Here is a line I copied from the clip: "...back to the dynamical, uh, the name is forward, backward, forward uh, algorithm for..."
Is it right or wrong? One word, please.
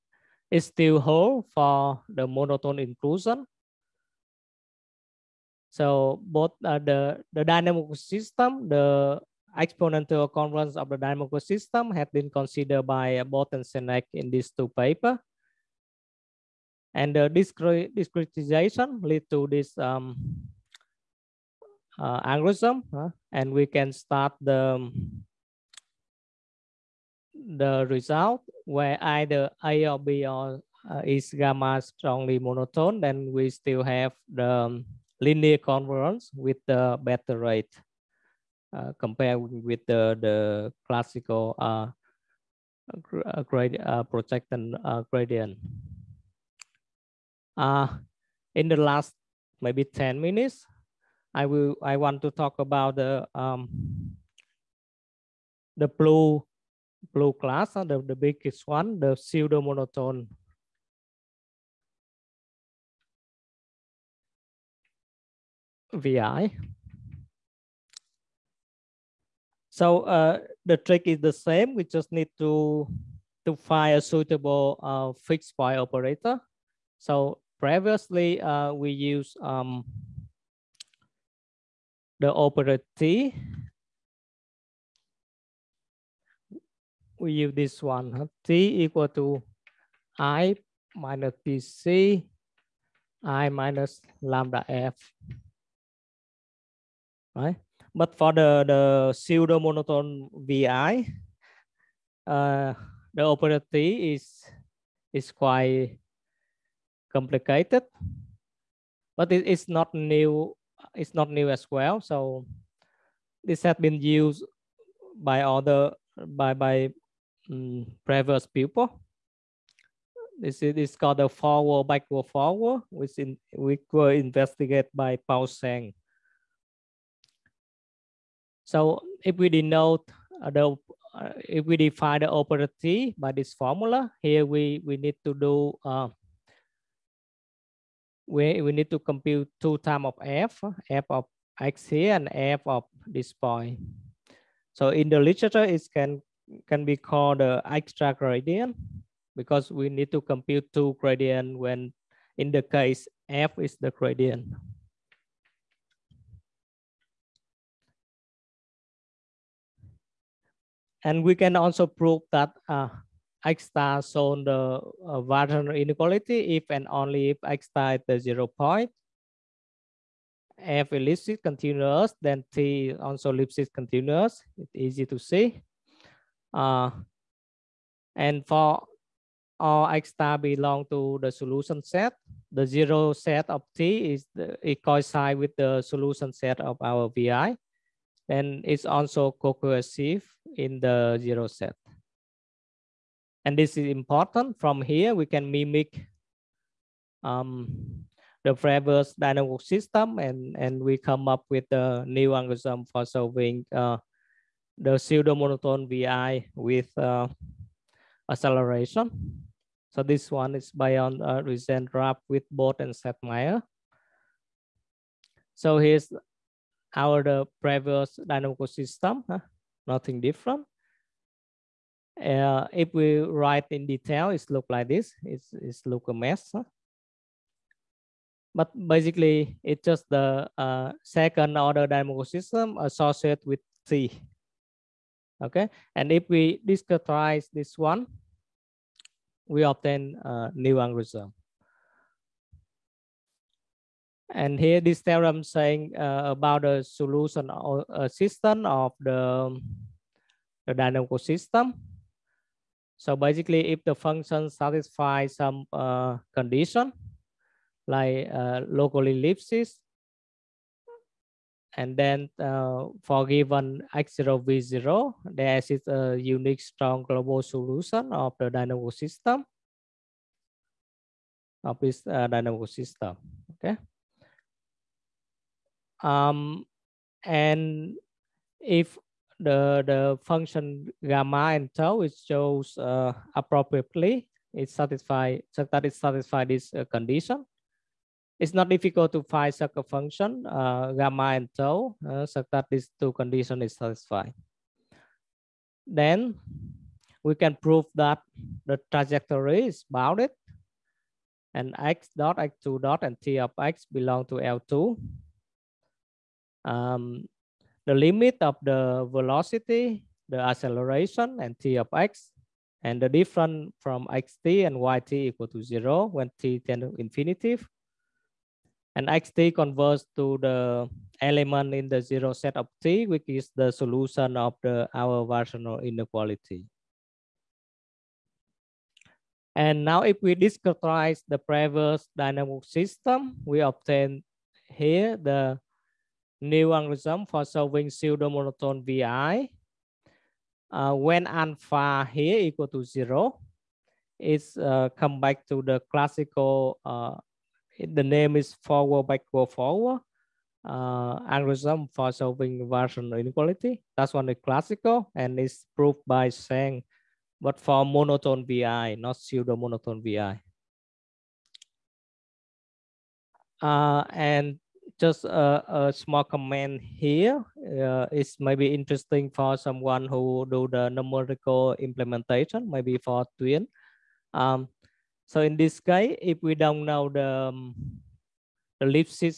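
wrong.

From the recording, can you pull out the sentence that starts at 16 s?
And the uh, discretization lead to this um, uh, algorithm, huh?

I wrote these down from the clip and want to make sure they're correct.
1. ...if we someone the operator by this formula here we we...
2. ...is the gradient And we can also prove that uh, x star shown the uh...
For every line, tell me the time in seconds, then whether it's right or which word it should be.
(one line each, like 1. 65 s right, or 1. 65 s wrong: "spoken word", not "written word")
1. 131 s wrong: "define", not "someone"
2. 153 s right.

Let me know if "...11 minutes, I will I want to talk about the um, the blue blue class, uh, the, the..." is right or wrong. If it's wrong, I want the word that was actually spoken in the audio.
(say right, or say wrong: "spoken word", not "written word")
wrong: "10", not "11".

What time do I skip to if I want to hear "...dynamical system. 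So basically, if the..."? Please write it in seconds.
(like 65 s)
250 s.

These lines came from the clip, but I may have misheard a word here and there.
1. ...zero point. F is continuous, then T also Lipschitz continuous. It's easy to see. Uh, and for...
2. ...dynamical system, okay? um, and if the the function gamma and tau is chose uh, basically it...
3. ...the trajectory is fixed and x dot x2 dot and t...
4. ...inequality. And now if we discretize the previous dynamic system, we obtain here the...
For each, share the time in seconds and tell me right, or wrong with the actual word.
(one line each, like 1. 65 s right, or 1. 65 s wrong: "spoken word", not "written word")
1. 168 s right
2. 272 s wrong: "appropriately", not "basically"
3. 298 s wrong: "bounded", not "fixed"
4. 325 s right.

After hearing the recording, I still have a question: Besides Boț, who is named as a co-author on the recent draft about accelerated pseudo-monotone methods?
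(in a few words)
Sedlmayer.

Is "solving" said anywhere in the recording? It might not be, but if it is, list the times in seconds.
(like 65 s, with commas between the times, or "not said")
203 s, 337 s, 352 s.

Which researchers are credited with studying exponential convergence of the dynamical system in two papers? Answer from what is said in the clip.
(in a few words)
Bot and Csetnek.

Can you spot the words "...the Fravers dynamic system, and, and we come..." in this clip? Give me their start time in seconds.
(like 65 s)
198 s.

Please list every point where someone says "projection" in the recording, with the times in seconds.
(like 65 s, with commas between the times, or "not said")
44 s.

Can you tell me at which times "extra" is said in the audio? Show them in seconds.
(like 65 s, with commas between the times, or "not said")
147 s.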